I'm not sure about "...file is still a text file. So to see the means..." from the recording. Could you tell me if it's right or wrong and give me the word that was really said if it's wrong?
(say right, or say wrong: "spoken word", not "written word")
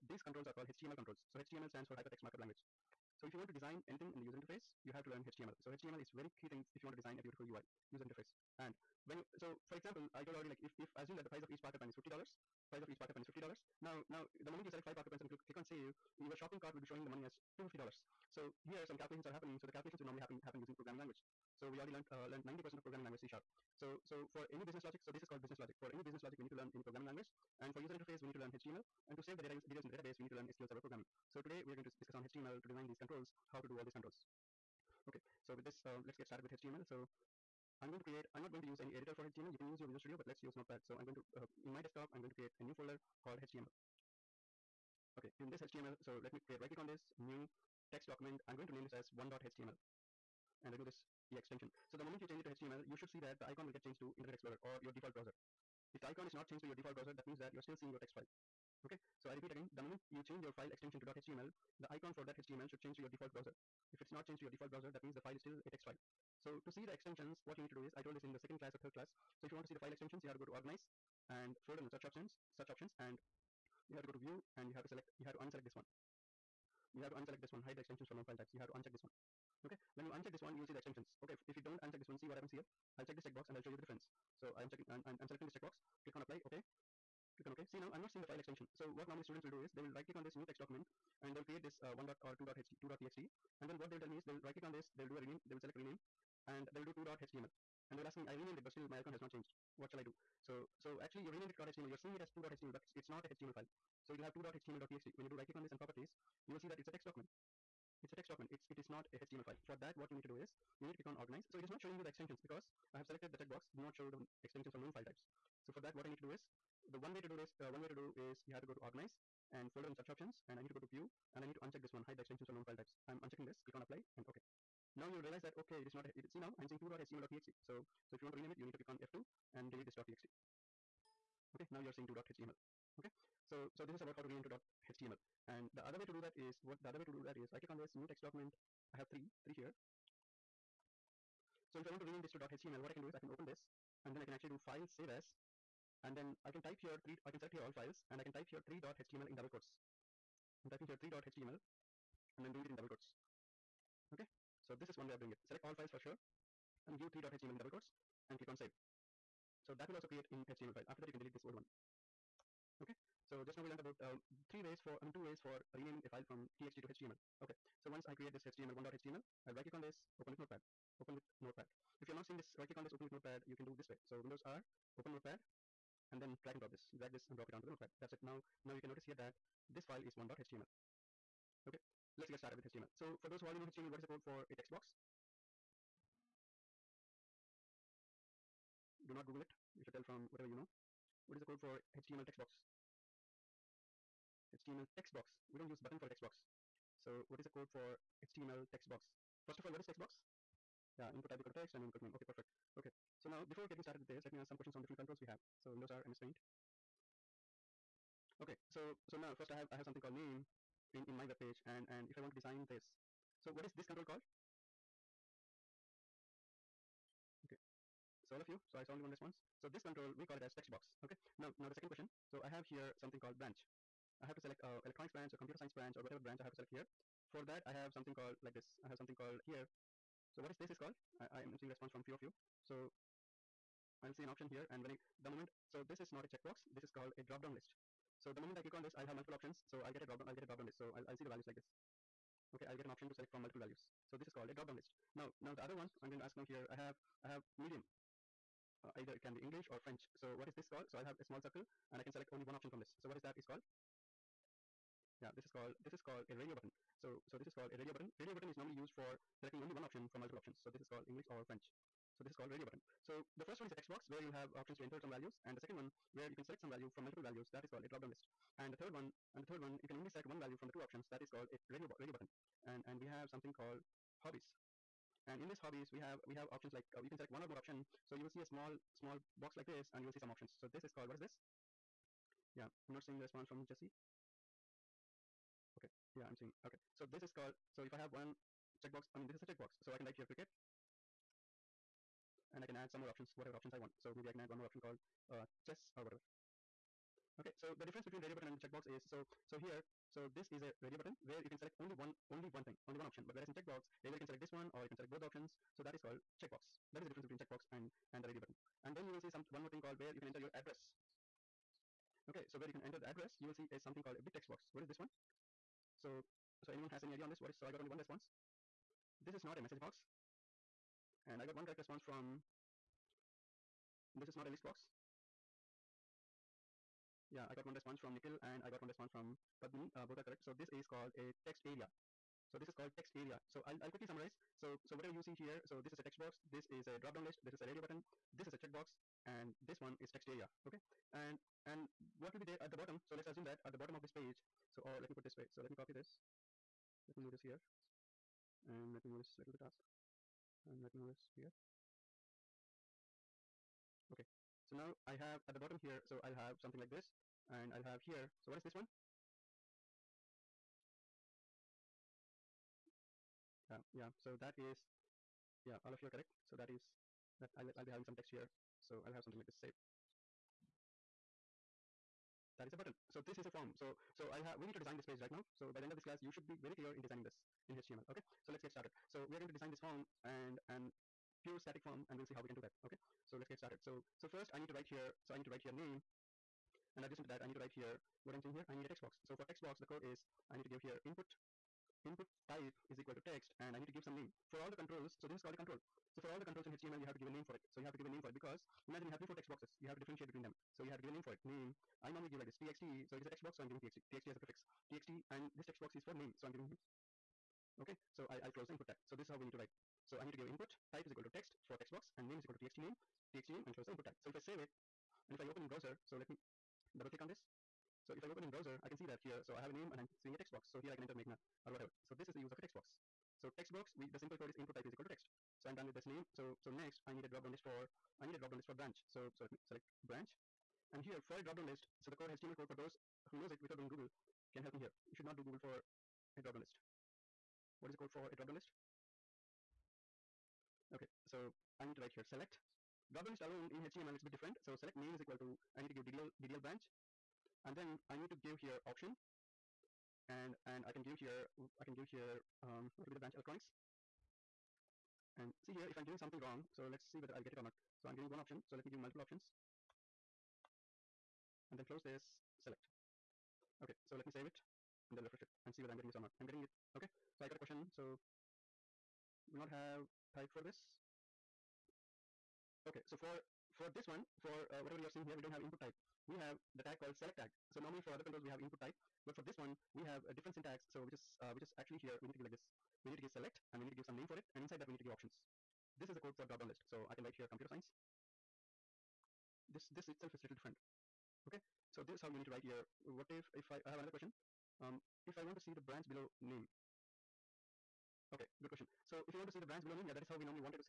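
wrong: "extensions", not "means".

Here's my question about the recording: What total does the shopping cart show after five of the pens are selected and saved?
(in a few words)
$250.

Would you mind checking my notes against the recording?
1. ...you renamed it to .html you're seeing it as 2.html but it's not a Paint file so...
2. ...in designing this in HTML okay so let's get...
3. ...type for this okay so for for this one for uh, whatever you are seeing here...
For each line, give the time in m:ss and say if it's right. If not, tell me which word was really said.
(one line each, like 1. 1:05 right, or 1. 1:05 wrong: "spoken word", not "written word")
1. 1:41 wrong: "HTML", not "Paint"
2. 6:16 right
3. 7:50 right.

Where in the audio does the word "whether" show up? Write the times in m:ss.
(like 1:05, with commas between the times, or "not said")
7:37, 7:45.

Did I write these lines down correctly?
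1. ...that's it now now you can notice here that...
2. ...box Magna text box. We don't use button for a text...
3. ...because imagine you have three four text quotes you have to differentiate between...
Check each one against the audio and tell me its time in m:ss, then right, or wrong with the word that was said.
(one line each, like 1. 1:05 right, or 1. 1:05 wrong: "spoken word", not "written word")
1. 2:57 right
2. 3:12 wrong: "HTML", not "Magna"
3. 6:38 wrong: "boxes", not "quotes".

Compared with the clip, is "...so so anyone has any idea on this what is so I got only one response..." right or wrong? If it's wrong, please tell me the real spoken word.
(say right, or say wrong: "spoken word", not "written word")
right.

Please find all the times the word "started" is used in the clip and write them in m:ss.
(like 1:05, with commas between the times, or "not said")
0:36, 3:02, 3:23, 6:18, 6:23.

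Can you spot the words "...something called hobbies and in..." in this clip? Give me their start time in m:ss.
4:33.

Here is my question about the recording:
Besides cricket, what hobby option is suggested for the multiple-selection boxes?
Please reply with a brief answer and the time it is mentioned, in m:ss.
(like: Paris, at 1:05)
chess, at 4:55.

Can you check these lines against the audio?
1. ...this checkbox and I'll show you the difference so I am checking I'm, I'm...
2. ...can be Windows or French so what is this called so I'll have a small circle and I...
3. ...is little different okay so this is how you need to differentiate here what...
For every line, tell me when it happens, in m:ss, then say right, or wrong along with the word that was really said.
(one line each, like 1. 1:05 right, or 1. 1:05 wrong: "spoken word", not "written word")
1. 1:23 right
2. 4:09 wrong: "English", not "Windows"
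3. 8:10 wrong: "write", not "differentiate".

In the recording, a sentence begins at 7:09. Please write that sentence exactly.
So so let me select branch.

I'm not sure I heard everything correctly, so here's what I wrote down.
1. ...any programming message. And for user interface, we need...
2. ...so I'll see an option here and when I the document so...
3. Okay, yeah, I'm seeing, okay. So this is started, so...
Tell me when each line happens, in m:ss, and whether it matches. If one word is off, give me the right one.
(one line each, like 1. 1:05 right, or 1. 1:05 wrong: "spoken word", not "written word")
1. 0:26 wrong: "language", not "message"
2. 3:52 wrong: "moment", not "document"
3. 4:45 wrong: "called", not "started".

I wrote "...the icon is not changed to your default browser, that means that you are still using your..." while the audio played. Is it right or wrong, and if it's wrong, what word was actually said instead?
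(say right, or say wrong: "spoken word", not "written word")
wrong: "seeing", not "using".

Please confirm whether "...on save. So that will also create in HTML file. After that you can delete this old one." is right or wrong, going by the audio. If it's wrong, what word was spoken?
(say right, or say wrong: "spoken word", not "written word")
right.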